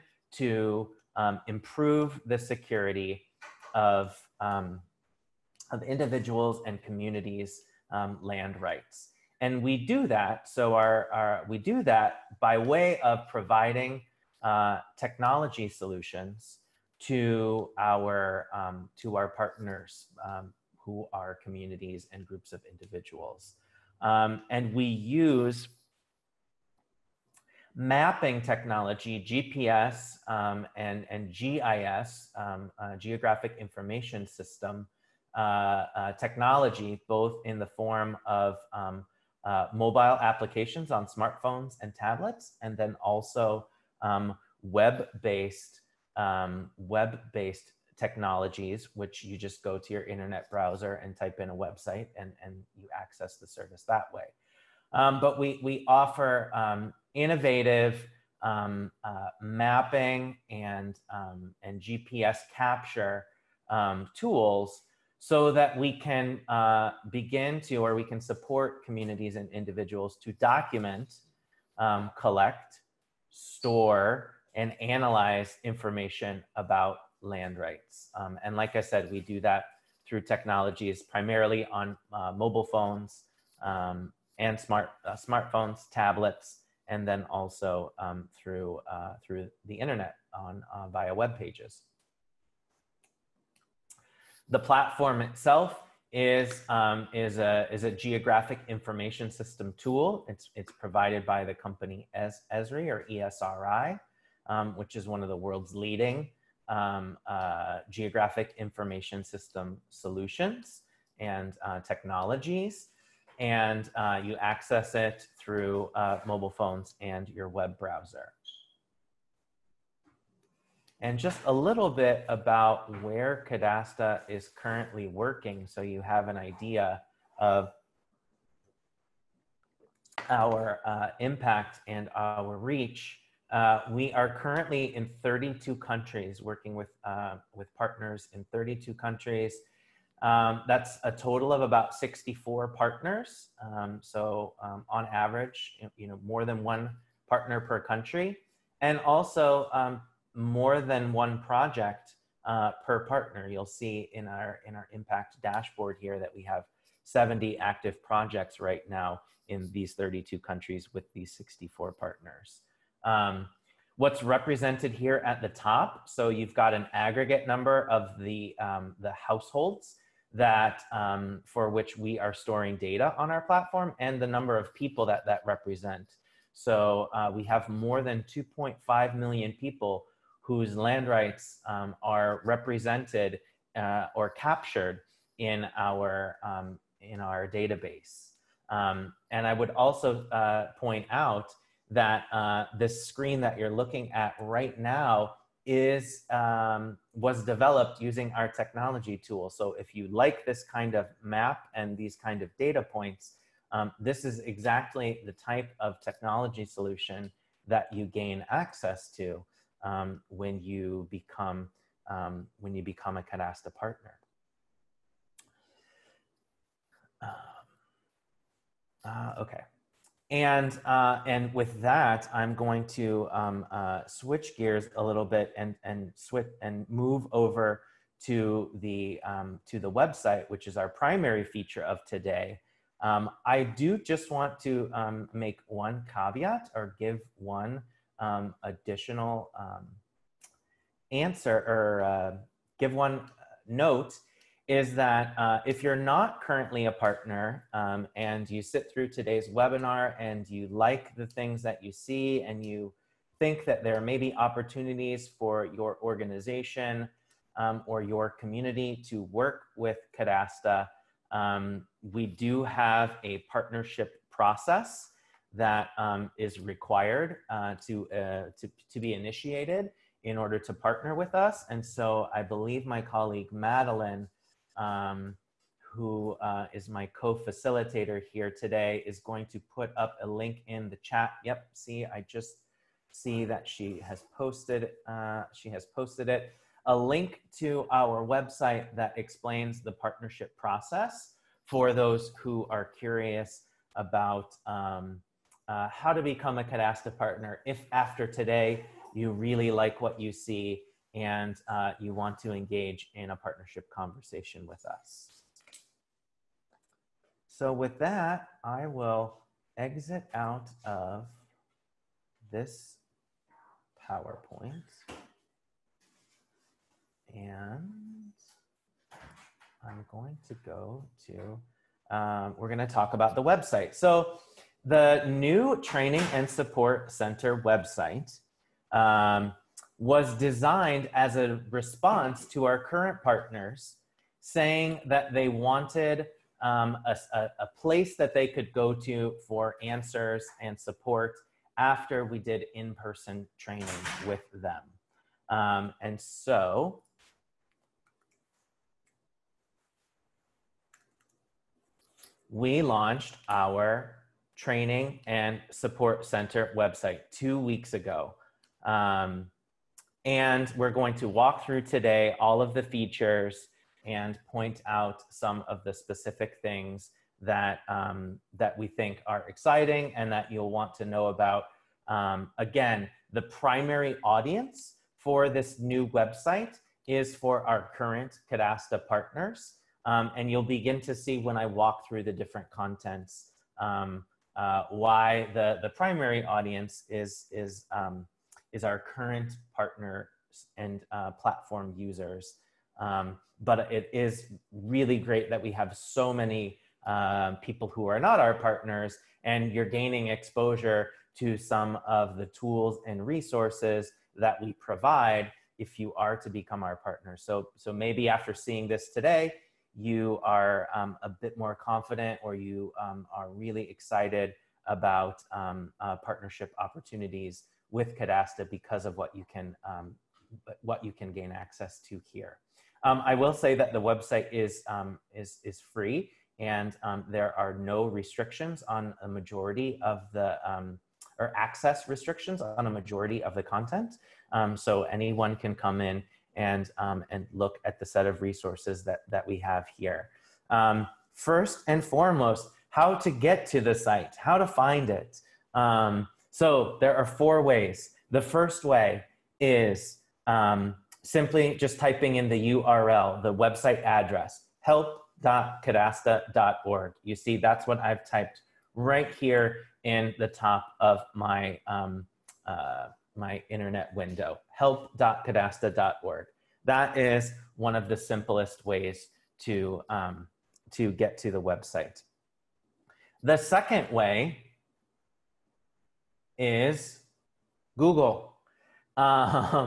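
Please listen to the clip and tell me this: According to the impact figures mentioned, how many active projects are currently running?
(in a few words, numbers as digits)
70.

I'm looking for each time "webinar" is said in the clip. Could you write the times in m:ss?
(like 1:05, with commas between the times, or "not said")
4:09.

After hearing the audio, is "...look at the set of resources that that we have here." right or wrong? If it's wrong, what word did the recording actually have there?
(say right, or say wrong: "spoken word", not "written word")
right.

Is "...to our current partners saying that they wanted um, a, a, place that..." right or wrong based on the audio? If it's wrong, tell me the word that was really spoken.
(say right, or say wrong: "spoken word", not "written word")
right.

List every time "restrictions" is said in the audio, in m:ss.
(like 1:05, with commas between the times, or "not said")
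7:08, 7:12.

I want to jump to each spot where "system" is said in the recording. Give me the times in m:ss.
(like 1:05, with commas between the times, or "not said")
0:34, 1:39, 1:49.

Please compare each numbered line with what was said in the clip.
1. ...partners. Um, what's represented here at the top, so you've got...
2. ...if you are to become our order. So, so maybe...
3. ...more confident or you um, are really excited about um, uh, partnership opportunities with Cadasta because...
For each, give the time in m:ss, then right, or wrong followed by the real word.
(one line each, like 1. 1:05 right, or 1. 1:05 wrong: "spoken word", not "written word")
1. 2:41 right
2. 6:45 wrong: "partner", not "order"
3. 6:51 right.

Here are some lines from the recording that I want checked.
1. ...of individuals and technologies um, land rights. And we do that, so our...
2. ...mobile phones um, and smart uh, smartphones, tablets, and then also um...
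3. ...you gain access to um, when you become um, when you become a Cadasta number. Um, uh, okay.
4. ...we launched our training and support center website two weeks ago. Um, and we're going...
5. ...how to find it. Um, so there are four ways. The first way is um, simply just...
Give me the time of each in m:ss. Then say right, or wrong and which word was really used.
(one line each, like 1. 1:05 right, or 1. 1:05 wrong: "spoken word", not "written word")
1. 0:05 wrong: "communities", not "technologies"
2. 1:22 right
3. 3:27 wrong: "partner", not "number"
4. 5:52 right
5. 7:24 right.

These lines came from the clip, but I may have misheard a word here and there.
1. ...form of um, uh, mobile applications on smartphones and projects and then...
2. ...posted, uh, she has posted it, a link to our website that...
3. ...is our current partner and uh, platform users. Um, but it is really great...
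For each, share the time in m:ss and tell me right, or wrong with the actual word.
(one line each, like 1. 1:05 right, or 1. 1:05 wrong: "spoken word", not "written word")
1. 0:37 wrong: "tablets", not "projects"
2. 4:44 right
3. 6:28 right.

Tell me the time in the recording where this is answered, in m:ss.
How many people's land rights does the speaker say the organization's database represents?
2:57.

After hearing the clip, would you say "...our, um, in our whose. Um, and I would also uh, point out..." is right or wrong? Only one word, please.
wrong.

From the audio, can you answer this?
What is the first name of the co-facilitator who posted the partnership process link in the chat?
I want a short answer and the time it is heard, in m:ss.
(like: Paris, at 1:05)
Madeline, at 4:33.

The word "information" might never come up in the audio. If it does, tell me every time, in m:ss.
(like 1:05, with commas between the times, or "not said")
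0:33, 1:15, 1:38, 1:48.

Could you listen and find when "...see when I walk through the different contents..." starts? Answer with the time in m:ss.
6:21.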